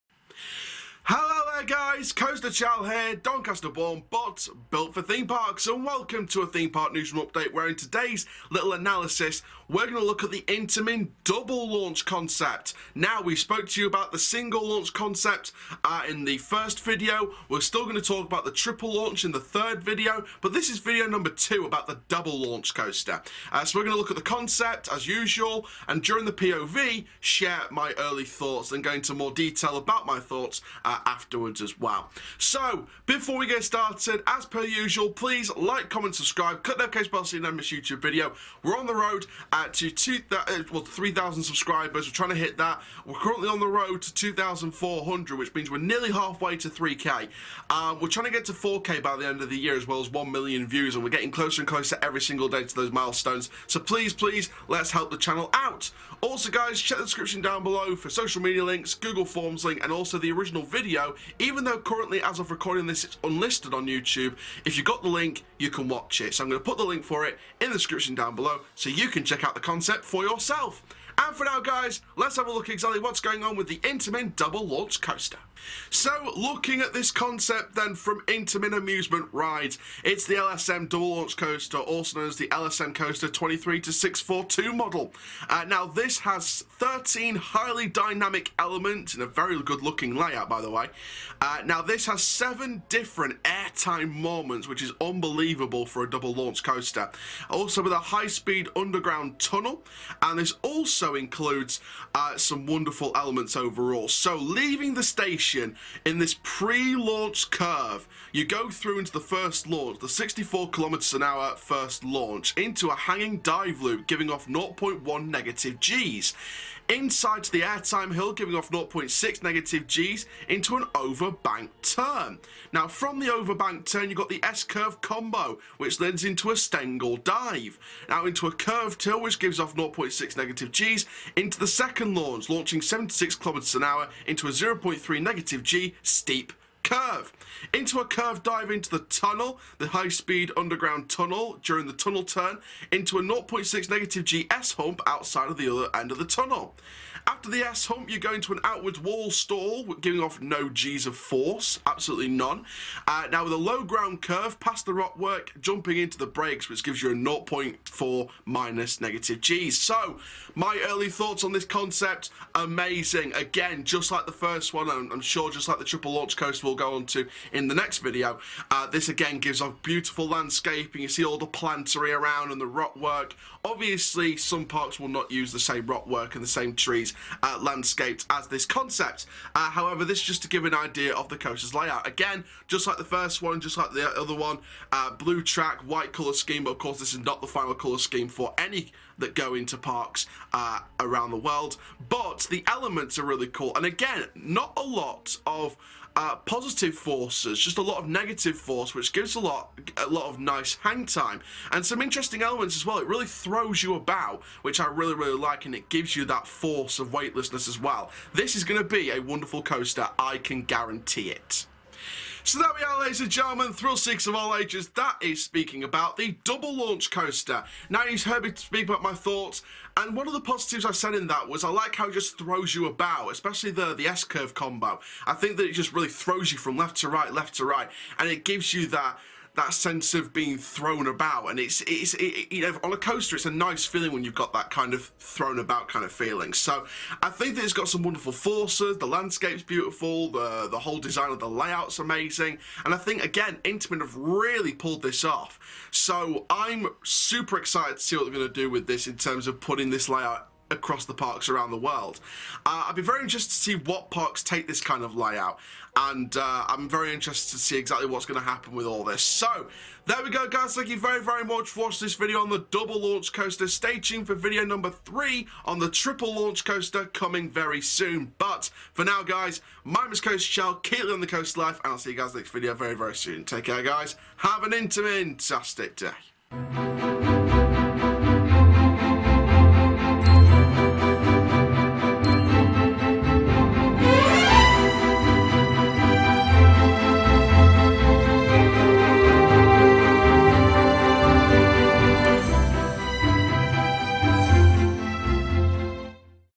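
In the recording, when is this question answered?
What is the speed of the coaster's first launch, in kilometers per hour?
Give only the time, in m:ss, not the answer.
1:50.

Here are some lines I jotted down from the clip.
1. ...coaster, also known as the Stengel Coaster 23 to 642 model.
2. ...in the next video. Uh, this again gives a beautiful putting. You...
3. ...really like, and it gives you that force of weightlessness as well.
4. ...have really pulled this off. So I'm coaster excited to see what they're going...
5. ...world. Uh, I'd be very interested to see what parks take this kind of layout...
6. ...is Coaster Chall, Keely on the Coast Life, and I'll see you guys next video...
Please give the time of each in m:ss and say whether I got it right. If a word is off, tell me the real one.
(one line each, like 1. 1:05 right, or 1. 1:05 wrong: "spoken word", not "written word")
1. 1:21 wrong: "LSM", not "Stengel"
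2. 2:47 wrong: "landscaping", not "putting"
3. 3:25 right
4. 4:04 wrong: "super", not "coaster"
5. 4:11 right
6. 4:30 right.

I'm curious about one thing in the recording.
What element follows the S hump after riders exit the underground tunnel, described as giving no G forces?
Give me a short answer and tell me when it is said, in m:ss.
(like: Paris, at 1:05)
Outward wall stall, at 2:28.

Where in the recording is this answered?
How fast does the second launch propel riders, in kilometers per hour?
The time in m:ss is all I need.
2:12.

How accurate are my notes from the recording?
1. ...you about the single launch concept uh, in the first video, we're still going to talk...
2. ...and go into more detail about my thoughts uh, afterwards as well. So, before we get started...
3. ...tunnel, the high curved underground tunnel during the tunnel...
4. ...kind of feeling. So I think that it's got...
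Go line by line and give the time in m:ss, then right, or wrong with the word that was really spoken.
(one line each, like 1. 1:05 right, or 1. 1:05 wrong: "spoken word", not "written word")
1. 0:13 right
2. 0:28 right
3. 2:19 wrong: "speed", not "curved"
4. 3:55 right.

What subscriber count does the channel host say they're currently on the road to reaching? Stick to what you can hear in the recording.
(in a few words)
2,400.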